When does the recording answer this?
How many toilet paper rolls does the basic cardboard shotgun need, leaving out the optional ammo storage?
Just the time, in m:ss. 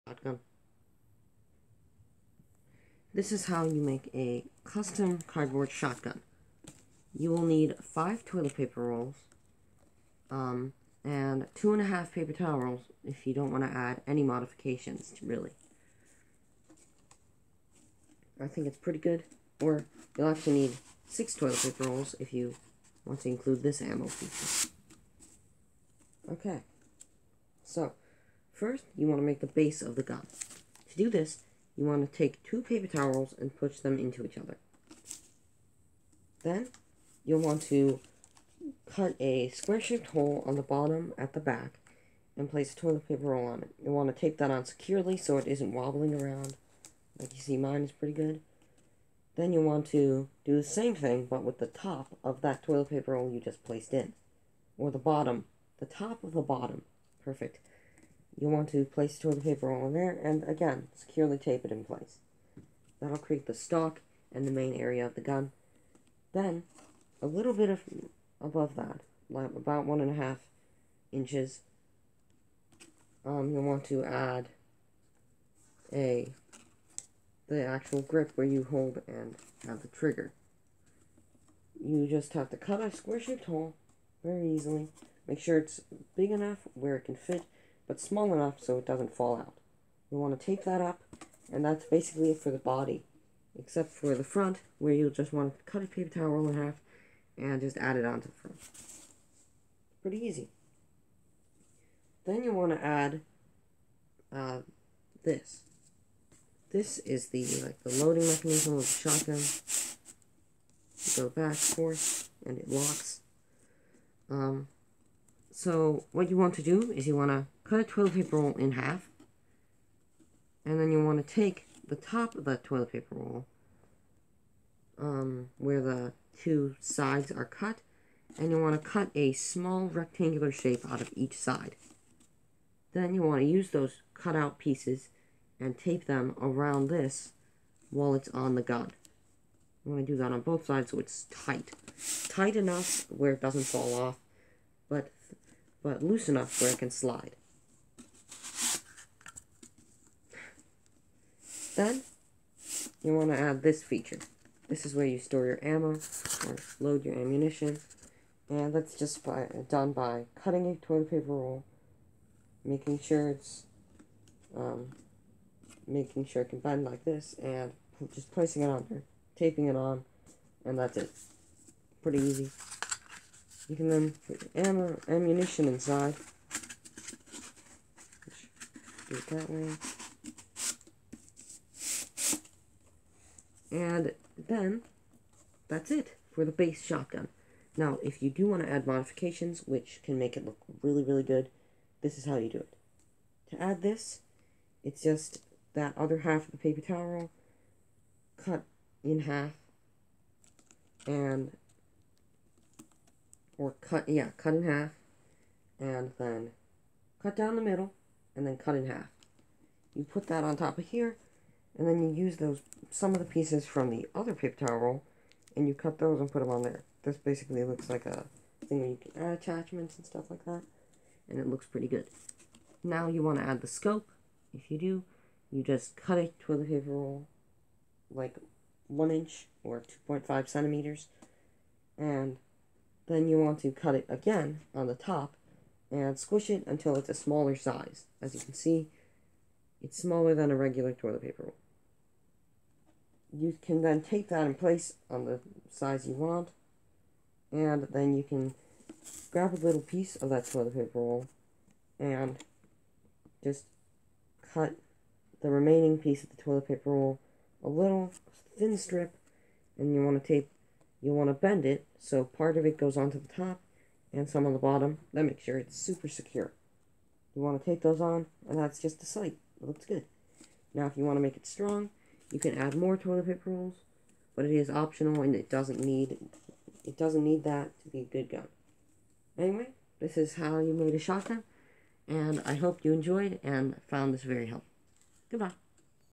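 0:07.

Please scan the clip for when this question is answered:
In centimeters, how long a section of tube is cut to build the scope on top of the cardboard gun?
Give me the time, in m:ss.
3:50.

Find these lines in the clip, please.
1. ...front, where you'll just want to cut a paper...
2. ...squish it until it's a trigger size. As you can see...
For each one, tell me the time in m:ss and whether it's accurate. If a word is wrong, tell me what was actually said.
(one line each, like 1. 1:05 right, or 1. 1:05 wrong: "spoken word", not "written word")
1. 1:34 right
2. 3:56 wrong: "smaller", not "trigger".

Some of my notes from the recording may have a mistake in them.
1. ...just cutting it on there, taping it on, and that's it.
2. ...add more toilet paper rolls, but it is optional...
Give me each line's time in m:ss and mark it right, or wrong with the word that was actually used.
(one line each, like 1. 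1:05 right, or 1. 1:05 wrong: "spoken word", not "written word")
1. 2:48 wrong: "placing", not "cutting"
2. 4:32 right.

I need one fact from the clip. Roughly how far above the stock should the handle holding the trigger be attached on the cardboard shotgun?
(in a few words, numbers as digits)
1.5 inches.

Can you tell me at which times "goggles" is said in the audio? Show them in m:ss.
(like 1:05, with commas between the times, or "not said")
not said.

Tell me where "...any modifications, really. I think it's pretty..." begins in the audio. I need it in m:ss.
0:14.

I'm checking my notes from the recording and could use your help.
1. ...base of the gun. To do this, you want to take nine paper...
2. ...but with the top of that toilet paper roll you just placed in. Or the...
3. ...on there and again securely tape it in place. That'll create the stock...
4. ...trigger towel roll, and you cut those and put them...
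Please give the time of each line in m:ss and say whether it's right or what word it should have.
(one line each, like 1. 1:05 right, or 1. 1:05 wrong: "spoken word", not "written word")
1. 0:29 wrong: "two", not "nine"
2. 0:51 right
3. 0:59 right
4. 3:34 wrong: "paper", not "trigger".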